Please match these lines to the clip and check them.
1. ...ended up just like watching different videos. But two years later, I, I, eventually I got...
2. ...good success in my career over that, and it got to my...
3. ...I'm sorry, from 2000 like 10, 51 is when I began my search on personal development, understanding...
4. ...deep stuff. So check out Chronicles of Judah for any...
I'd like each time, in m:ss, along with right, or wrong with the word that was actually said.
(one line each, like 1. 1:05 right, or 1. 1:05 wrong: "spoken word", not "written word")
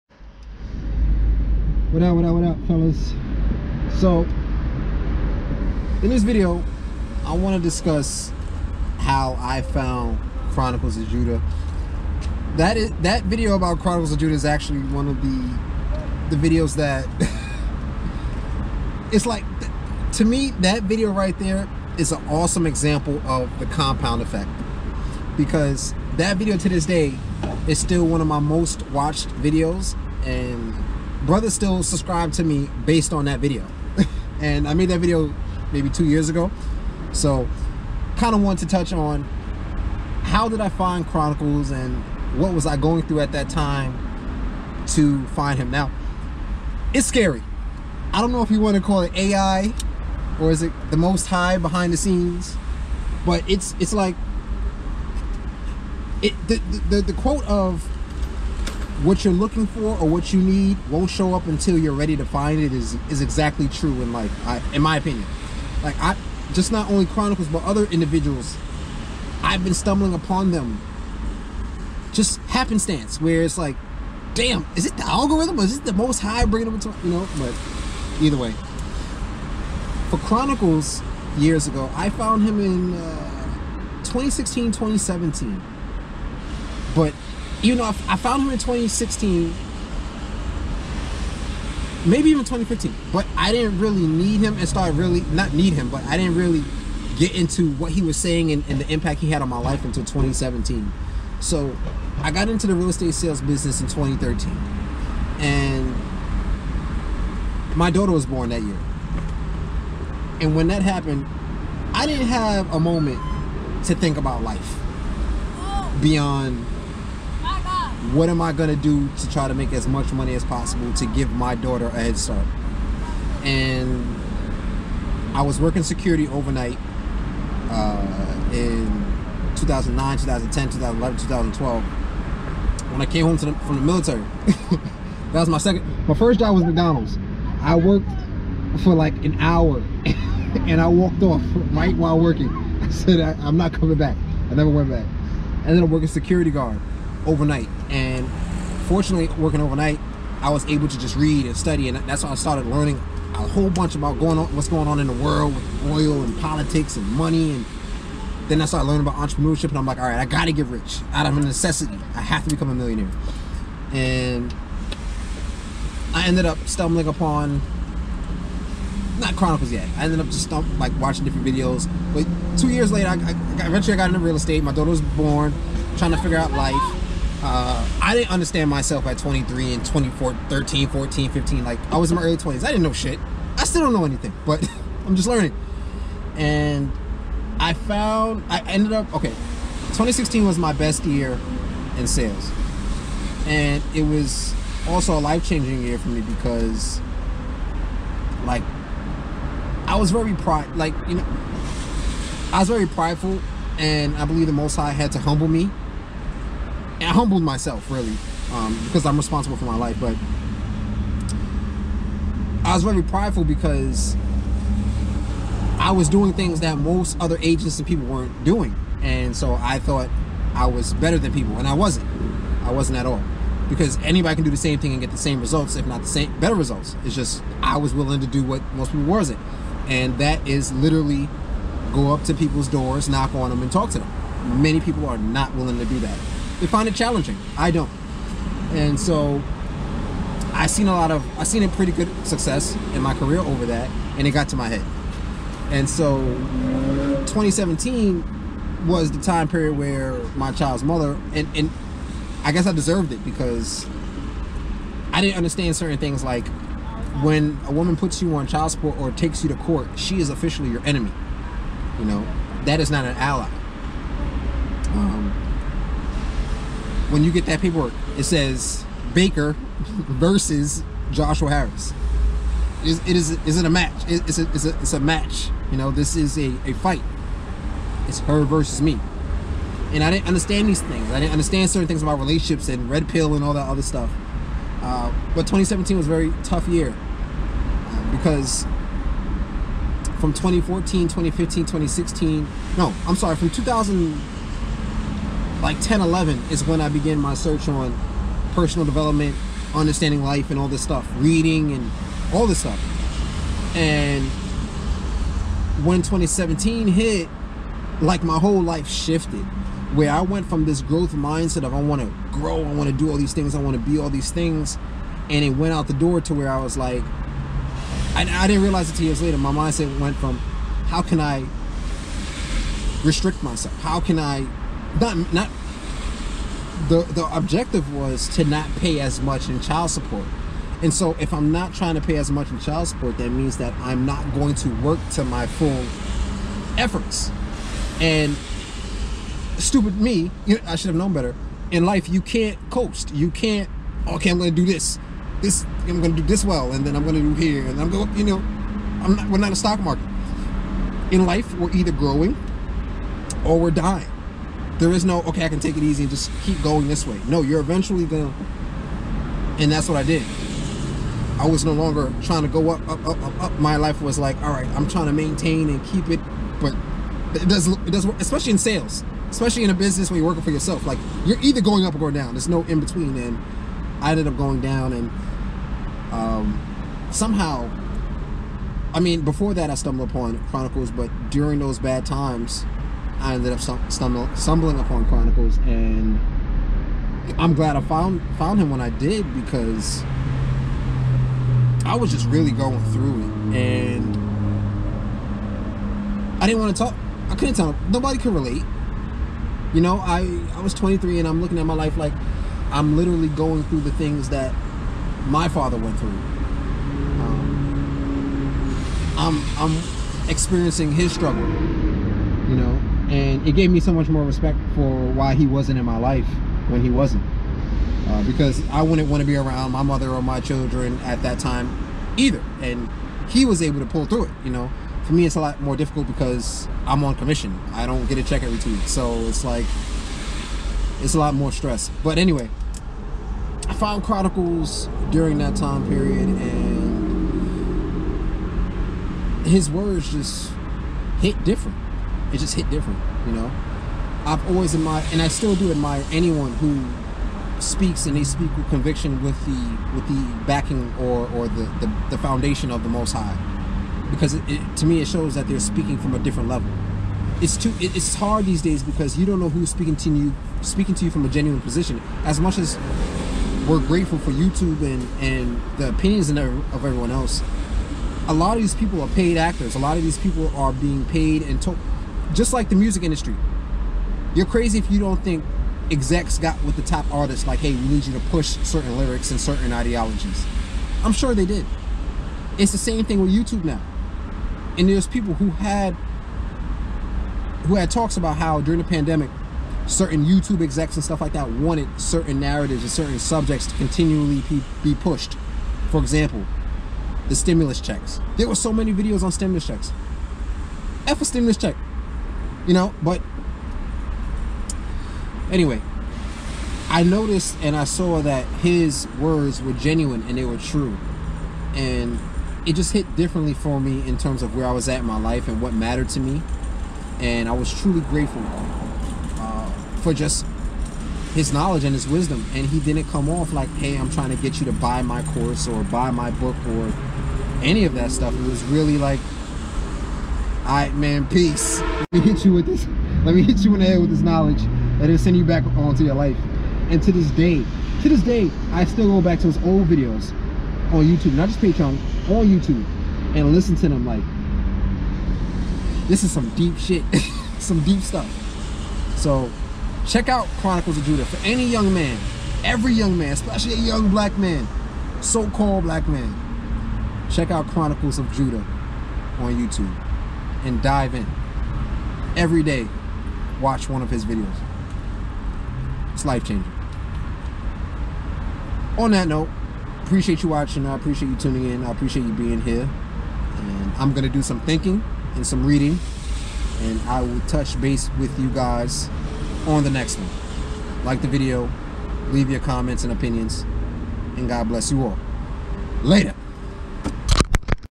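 1. 2:50 right
2. 4:01 right
3. 4:53 wrong: "11", not "51"
4. 9:07 right.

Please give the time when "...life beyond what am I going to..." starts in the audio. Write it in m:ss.
1:54.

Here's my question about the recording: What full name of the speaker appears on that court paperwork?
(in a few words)
Joshua Harris.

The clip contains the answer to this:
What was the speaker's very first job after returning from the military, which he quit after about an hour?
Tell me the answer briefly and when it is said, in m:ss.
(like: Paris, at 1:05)
McDonald's, at 2:16.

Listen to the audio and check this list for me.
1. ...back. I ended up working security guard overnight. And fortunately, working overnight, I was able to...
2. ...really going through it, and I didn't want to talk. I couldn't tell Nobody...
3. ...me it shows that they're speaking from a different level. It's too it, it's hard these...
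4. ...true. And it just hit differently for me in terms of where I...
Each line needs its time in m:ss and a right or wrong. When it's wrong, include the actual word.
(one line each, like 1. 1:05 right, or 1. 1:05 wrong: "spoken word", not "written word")
1. 2:24 right
2. 6:32 right
3. 7:34 right
4. 8:30 right.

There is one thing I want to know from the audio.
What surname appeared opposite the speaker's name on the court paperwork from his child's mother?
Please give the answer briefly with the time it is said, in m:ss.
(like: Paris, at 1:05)
Baker, at 4:29.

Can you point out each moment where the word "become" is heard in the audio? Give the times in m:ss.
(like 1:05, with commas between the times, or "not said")
2:42.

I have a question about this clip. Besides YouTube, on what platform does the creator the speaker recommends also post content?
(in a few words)
Patreon.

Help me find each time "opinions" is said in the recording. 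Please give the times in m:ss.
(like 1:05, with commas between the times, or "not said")
1:04, 7:45, 9:43.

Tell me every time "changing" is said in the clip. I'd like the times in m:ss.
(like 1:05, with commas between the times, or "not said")
3:15, 9:26.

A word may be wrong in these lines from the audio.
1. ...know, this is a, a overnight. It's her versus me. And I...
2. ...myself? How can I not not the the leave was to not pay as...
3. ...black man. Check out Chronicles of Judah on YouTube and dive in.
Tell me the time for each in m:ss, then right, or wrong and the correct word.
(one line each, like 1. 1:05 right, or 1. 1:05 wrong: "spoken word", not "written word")
1. 4:35 wrong: "fight", not "overnight"
2. 5:23 wrong: "objective", not "leave"
3. 9:15 right.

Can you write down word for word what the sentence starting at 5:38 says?
And stupid me, you know, I should have known better.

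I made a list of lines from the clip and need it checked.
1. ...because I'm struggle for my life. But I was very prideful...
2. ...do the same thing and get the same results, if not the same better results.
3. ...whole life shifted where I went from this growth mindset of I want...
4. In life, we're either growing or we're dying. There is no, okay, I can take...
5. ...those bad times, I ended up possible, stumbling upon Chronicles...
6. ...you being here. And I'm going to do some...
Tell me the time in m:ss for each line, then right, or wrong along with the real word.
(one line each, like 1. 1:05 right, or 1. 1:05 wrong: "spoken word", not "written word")
1. 3:28 wrong: "responsible", not "struggle"
2. 3:44 right
3. 5:08 right
4. 5:51 right
5. 6:21 wrong: "stumble", not "possible"
6. 9:32 right.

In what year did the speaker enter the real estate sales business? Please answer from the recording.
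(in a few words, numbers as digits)
2013.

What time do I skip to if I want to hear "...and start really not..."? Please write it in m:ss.
1:34.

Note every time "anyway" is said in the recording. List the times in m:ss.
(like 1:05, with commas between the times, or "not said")
7:12, 8:25.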